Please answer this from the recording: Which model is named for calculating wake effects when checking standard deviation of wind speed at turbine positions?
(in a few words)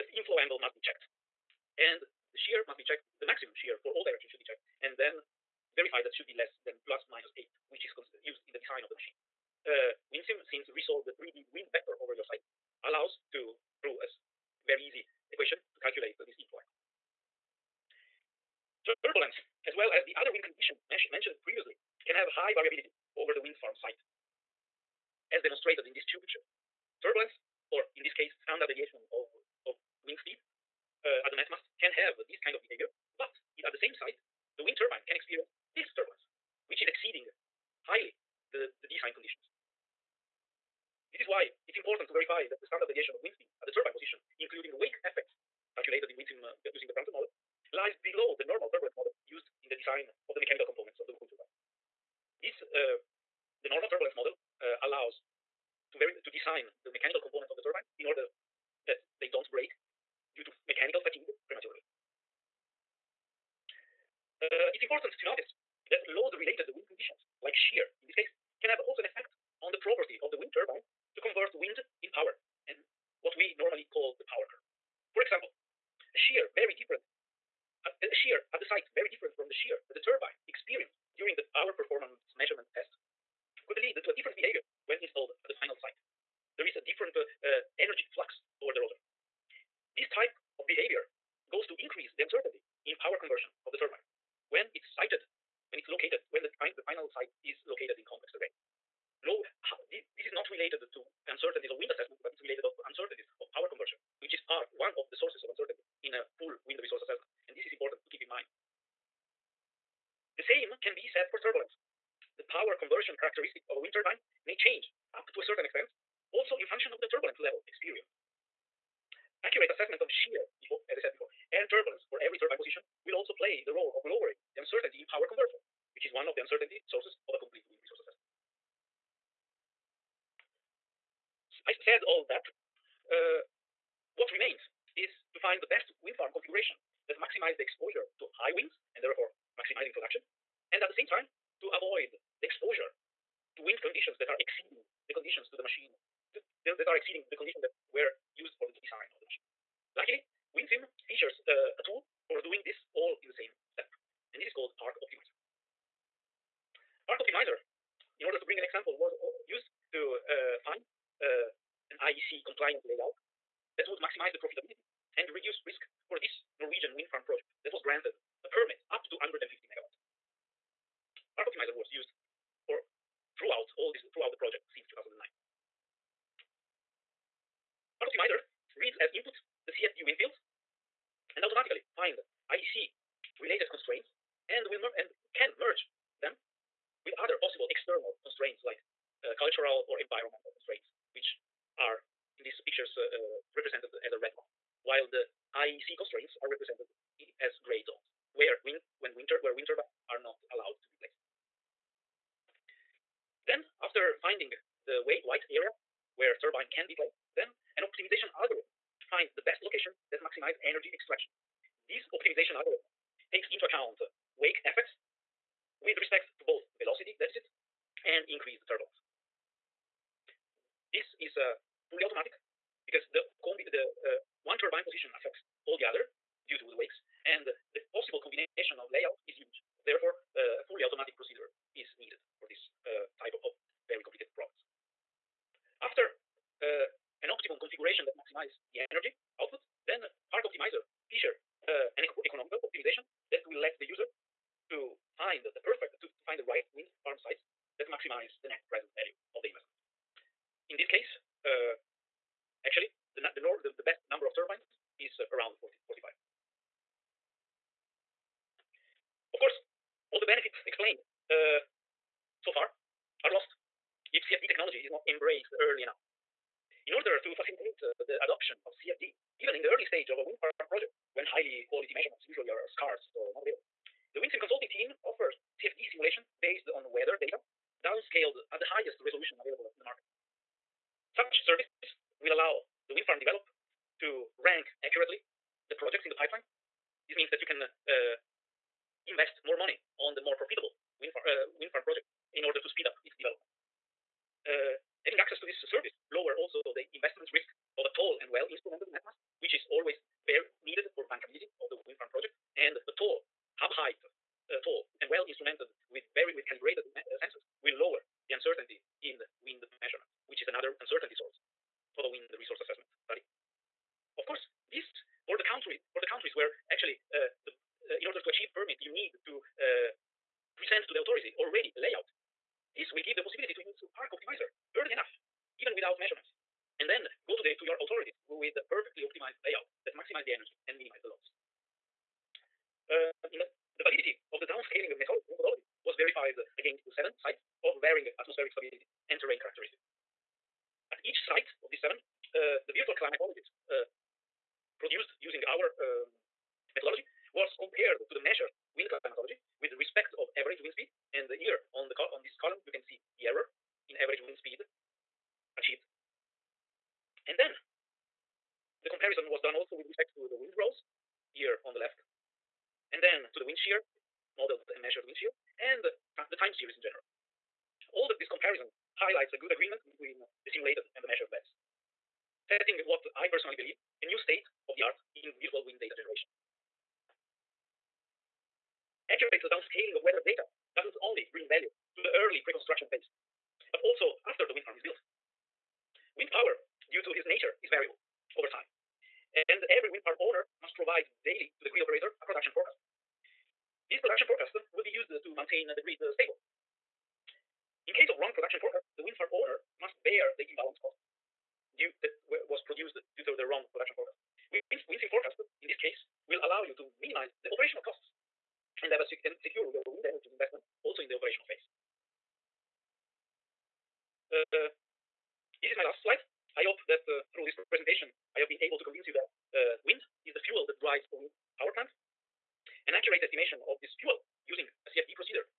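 Prandtl model.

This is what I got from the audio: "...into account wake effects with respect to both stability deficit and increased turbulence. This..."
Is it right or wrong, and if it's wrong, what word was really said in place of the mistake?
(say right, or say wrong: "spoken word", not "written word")
wrong: "velocity", not "stability".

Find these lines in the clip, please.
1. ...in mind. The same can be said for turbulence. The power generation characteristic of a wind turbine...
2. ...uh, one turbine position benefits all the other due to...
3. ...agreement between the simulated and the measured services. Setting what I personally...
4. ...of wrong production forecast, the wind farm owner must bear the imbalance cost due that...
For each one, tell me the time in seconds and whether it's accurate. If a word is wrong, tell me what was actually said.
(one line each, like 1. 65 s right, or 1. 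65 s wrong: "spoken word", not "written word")
1. 108 s wrong: "conversion", not "generation"
2. 224 s wrong: "affects", not "benefits"
3. 369 s wrong: "values", not "services"
4. 398 s right.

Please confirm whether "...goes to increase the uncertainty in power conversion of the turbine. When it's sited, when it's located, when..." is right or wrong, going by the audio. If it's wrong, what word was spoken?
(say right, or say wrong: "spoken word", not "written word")
right.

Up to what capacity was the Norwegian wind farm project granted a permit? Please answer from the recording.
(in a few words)
150 megawatt.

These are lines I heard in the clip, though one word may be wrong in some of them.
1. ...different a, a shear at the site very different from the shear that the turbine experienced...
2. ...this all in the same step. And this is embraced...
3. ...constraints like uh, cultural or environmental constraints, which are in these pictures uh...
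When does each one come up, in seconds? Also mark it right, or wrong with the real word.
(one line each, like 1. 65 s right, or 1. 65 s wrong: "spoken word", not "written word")
1. 76 s right
2. 152 s wrong: "called", not "embraced"
3. 188 s right.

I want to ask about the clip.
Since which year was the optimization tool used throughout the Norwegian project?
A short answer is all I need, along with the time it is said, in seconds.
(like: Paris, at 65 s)
2009, at 174 s.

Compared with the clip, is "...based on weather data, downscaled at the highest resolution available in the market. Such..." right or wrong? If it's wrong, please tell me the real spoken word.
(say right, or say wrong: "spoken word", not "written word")
right.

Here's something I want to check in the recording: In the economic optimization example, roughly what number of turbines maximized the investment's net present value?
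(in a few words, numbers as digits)
40 to 45.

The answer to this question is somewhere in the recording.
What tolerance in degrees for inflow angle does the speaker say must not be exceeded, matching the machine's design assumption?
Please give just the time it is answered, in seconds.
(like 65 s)
6 s.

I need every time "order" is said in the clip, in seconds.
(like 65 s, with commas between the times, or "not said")
58 s, 158 s, 266 s, 292 s, 318 s.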